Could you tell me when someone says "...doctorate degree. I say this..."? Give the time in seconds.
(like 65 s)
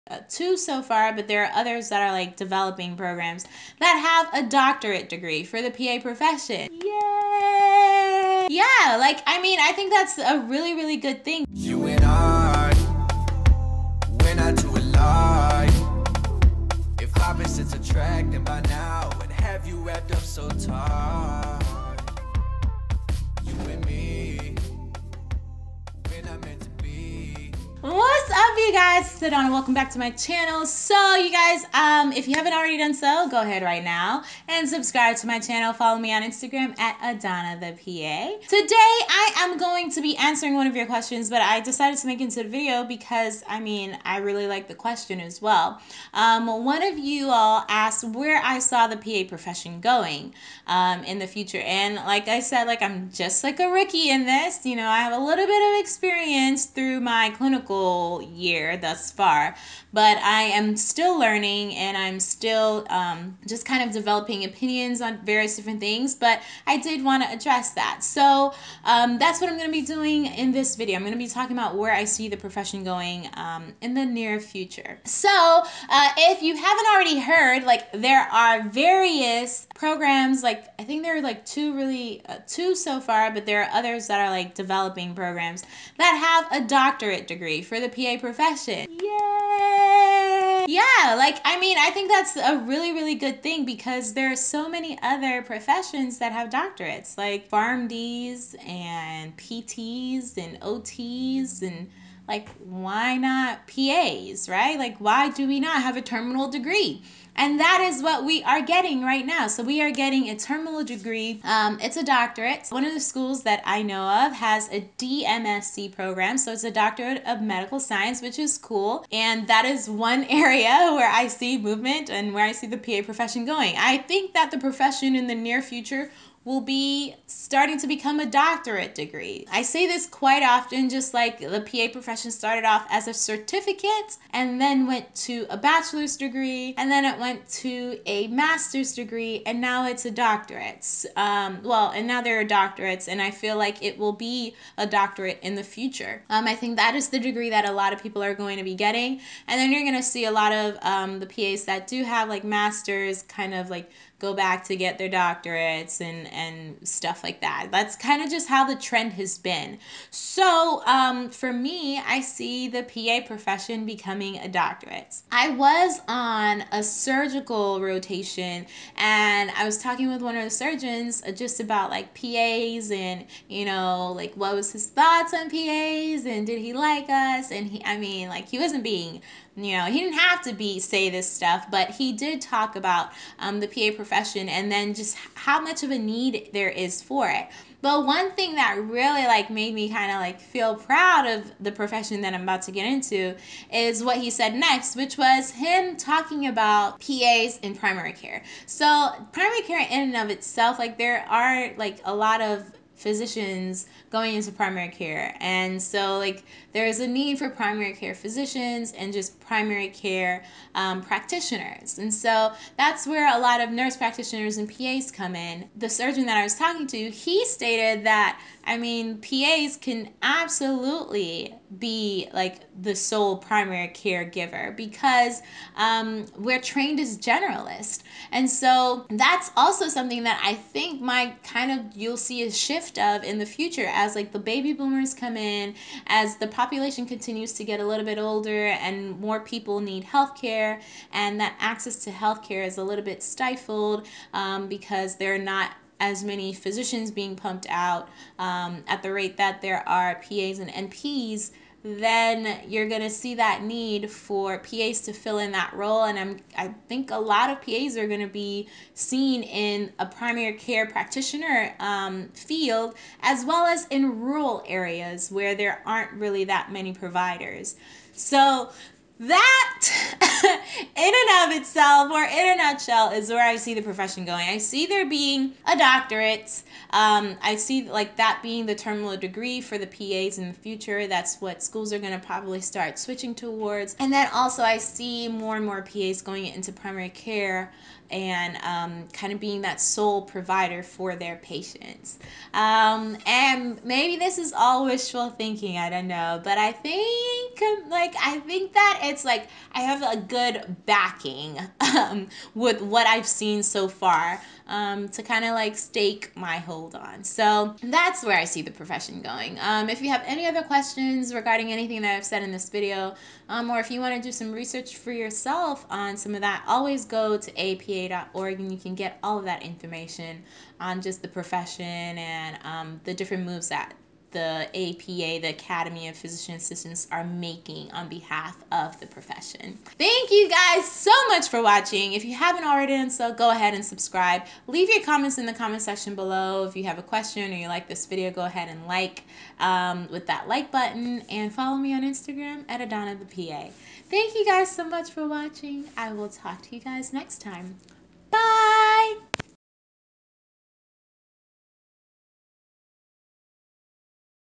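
128 s.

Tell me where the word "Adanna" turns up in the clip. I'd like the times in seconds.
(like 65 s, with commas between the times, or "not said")
36 s, 342 s.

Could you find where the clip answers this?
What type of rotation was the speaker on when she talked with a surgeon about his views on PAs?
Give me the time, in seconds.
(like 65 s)
166 s.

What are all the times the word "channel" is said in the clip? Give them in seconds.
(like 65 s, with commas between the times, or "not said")
30 s, 35 s.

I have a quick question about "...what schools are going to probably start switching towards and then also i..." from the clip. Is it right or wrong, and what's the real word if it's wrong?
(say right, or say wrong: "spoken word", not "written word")
right.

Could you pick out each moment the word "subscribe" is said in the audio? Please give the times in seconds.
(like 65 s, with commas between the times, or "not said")
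34 s, 333 s.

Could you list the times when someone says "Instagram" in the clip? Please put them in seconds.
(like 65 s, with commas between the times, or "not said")
36 s, 342 s.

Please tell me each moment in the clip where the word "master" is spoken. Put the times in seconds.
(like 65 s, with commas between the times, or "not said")
138 s, 152 s.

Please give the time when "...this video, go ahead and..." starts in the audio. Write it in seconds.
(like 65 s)
337 s.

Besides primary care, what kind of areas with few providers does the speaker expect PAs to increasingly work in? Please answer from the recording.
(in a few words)
Rural areas.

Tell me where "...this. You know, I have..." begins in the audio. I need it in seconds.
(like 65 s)
54 s.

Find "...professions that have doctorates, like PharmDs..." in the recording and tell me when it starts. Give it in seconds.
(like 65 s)
95 s.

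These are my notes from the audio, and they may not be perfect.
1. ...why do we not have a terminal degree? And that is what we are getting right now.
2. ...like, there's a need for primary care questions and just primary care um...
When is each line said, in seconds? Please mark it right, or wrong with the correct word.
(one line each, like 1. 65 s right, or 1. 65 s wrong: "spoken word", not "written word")
1. 104 s right
2. 206 s wrong: "physicians", not "questions".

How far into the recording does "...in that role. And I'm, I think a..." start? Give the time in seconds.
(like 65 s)
255 s.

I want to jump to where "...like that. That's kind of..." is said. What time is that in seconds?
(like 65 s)
157 s.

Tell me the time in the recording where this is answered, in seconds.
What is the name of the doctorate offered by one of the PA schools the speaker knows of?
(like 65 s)
116 s.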